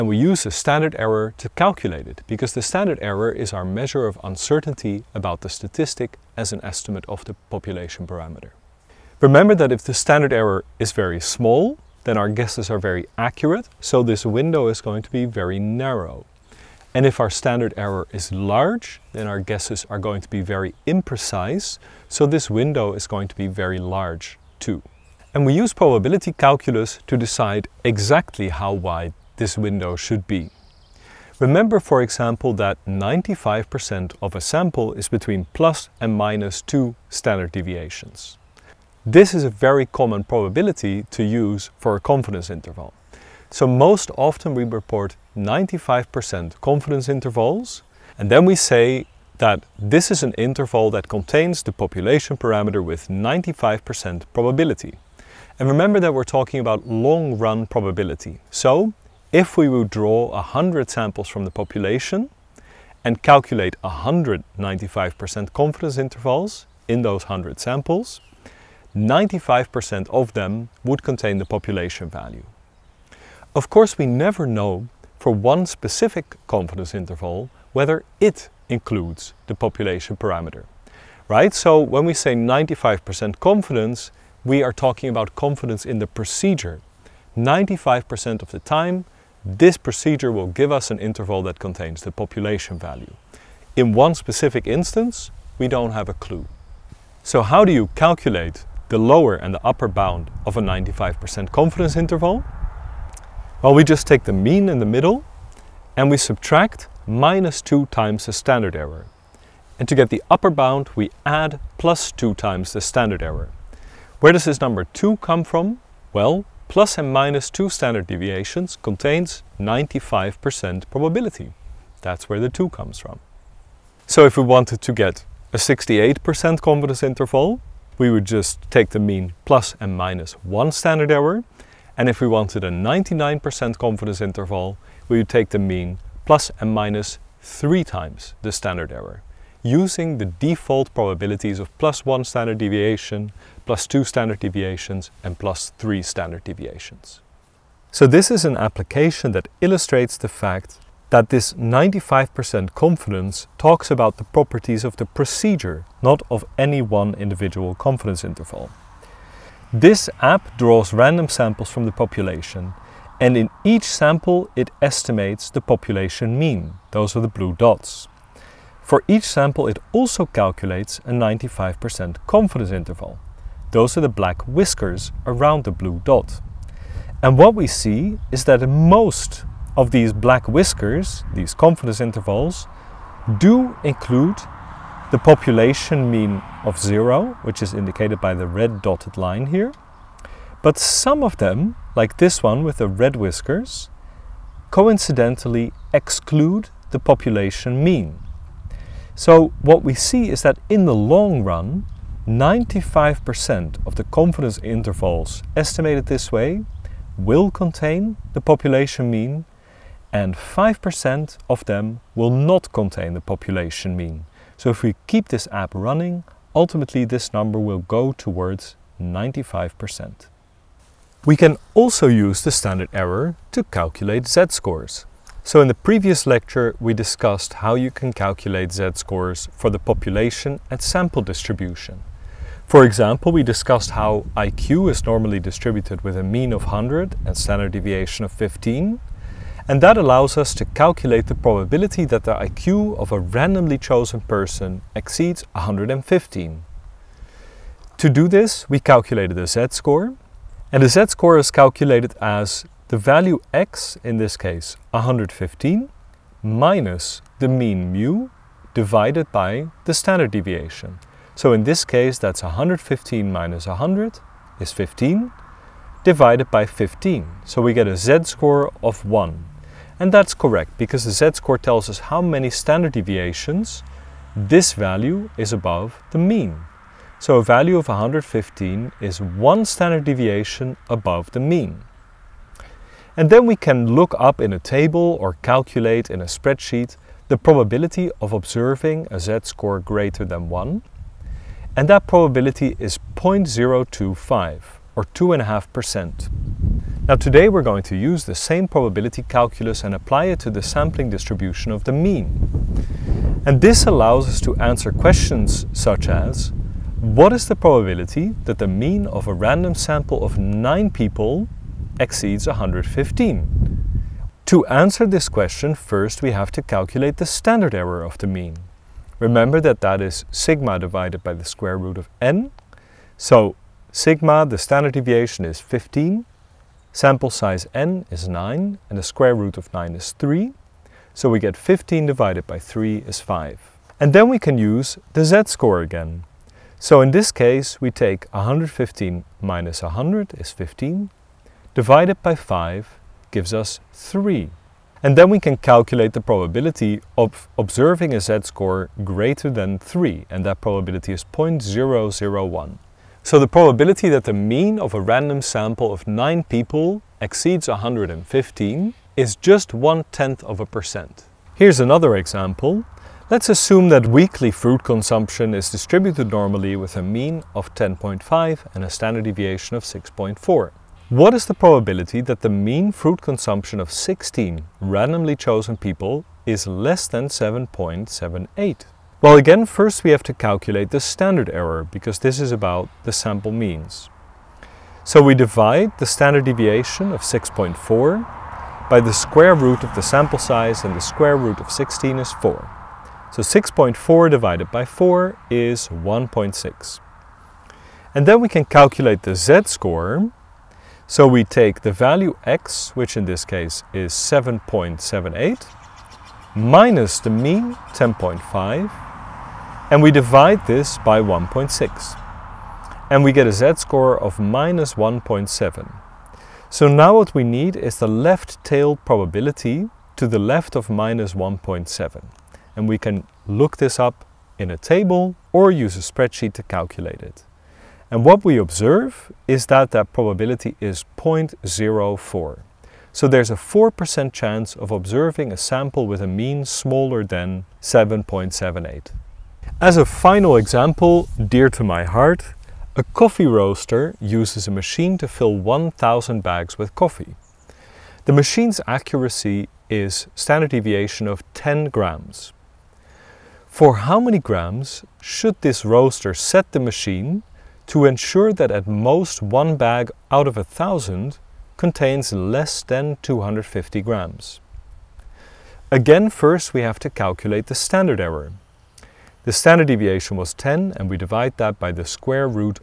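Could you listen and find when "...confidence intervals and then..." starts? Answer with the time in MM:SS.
00:46.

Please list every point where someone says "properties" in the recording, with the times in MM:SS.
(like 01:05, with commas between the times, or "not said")
02:34.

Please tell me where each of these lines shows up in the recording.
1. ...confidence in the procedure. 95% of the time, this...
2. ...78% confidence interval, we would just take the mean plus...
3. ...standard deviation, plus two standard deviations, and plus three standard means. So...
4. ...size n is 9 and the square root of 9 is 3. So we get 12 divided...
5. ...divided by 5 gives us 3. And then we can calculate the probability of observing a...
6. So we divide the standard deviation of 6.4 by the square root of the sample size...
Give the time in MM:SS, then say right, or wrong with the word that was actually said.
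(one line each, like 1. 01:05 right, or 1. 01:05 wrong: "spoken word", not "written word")
1. 01:25 right
2. 02:05 wrong: "68", not "78"
3. 02:22 wrong: "deviations", not "means"
4. 05:27 wrong: "15", not "12"
5. 05:41 right
6. 06:25 right.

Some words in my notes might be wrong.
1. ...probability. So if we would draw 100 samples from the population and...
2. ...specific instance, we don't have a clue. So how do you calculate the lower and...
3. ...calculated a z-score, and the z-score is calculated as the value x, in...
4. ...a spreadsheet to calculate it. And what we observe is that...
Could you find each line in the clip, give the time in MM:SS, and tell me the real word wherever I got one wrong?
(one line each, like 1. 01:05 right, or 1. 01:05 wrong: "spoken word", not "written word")
1. 00:57 right
2. 01:34 right
3. 04:08 right
4. 07:05 right.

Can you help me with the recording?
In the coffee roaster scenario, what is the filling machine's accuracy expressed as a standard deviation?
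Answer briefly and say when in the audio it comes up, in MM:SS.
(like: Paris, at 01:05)
10 grams, at 07:31.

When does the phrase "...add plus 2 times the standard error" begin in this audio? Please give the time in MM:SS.
01:51.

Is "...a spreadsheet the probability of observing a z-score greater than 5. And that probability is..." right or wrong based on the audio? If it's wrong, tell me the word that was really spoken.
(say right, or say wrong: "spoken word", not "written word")
wrong: "1", not "5".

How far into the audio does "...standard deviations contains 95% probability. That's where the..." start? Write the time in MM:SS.
01:57.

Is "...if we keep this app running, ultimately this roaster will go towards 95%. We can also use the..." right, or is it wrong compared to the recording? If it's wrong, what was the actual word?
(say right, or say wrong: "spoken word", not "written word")
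wrong: "number", not "roaster".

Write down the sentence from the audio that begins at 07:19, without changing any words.
As a final example, dear to my heart, a coffee roaster uses a machine to fill 1,000 bags with coffee.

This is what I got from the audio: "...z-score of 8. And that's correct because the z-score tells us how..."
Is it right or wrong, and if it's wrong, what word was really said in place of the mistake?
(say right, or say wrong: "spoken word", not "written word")
wrong: "1", not "8".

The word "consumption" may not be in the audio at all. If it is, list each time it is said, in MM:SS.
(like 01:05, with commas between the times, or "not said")
06:04, 06:13.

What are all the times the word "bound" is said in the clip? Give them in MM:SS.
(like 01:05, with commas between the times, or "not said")
01:39, 01:50.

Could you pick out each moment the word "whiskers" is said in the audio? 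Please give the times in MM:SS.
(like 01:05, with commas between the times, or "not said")
02:54, 03:00, 03:13.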